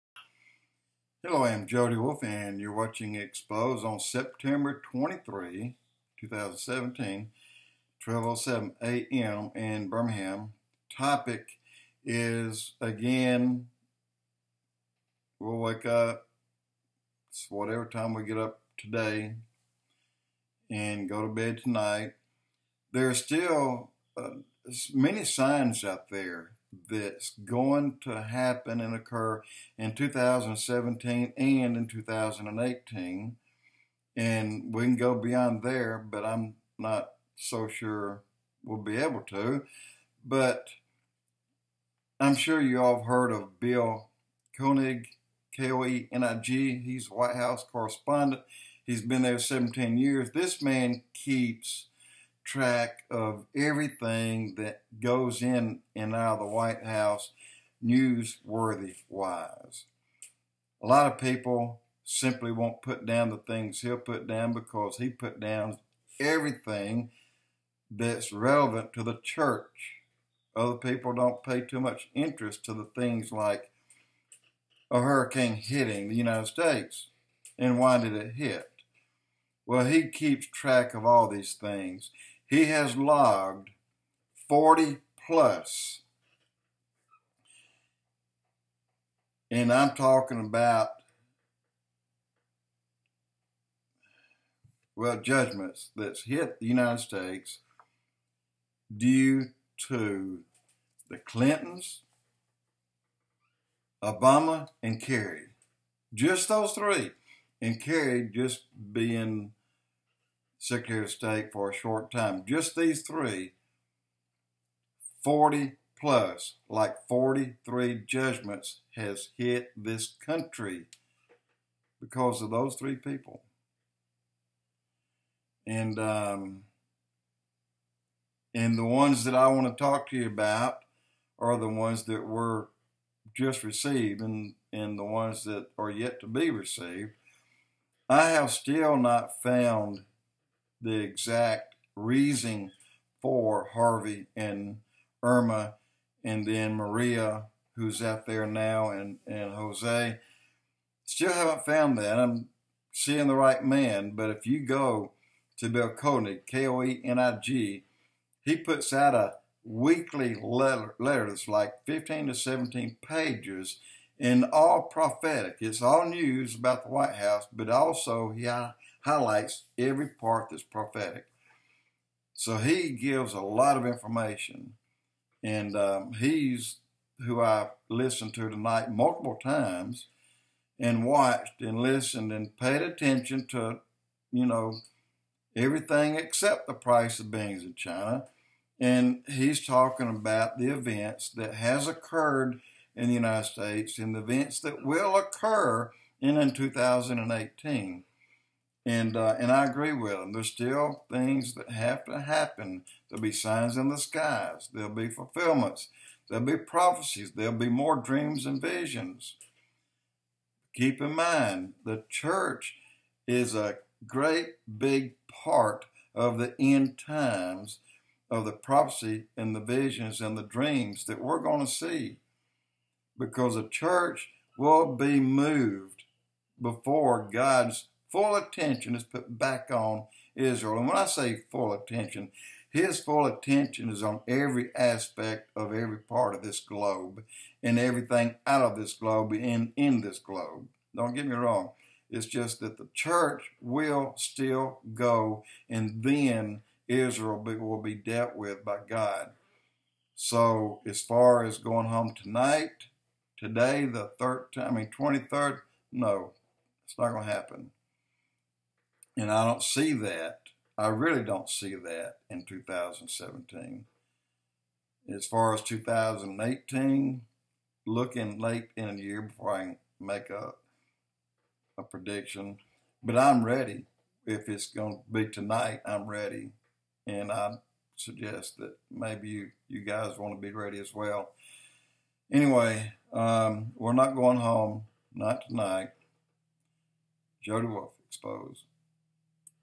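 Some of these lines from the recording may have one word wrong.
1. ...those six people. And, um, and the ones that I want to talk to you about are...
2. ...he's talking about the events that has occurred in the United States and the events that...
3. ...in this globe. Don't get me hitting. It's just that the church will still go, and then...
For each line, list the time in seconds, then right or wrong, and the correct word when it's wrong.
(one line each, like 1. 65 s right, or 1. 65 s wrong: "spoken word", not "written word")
1. 122 s wrong: "three", not "six"
2. 189 s right
3. 239 s wrong: "wrong", not "hitting".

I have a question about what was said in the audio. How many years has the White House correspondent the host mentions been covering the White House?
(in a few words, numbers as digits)
17 years.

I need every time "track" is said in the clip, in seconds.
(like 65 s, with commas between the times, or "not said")
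52 s, 80 s.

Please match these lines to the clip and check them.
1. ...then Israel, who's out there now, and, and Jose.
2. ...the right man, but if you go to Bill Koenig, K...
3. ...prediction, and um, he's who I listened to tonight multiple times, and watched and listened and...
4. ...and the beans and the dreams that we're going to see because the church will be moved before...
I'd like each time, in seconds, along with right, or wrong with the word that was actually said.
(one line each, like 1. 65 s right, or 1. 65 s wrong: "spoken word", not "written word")
1. 146 s wrong: "Maria", not "Israel"
2. 153 s right
3. 173 s wrong: "information", not "prediction"
4. 219 s wrong: "visions", not "beans".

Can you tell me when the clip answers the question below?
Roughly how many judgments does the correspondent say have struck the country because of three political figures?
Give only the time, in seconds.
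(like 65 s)
116 s.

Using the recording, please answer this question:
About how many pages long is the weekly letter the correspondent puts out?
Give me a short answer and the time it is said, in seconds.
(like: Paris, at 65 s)
15 to 17 pages, at 161 s.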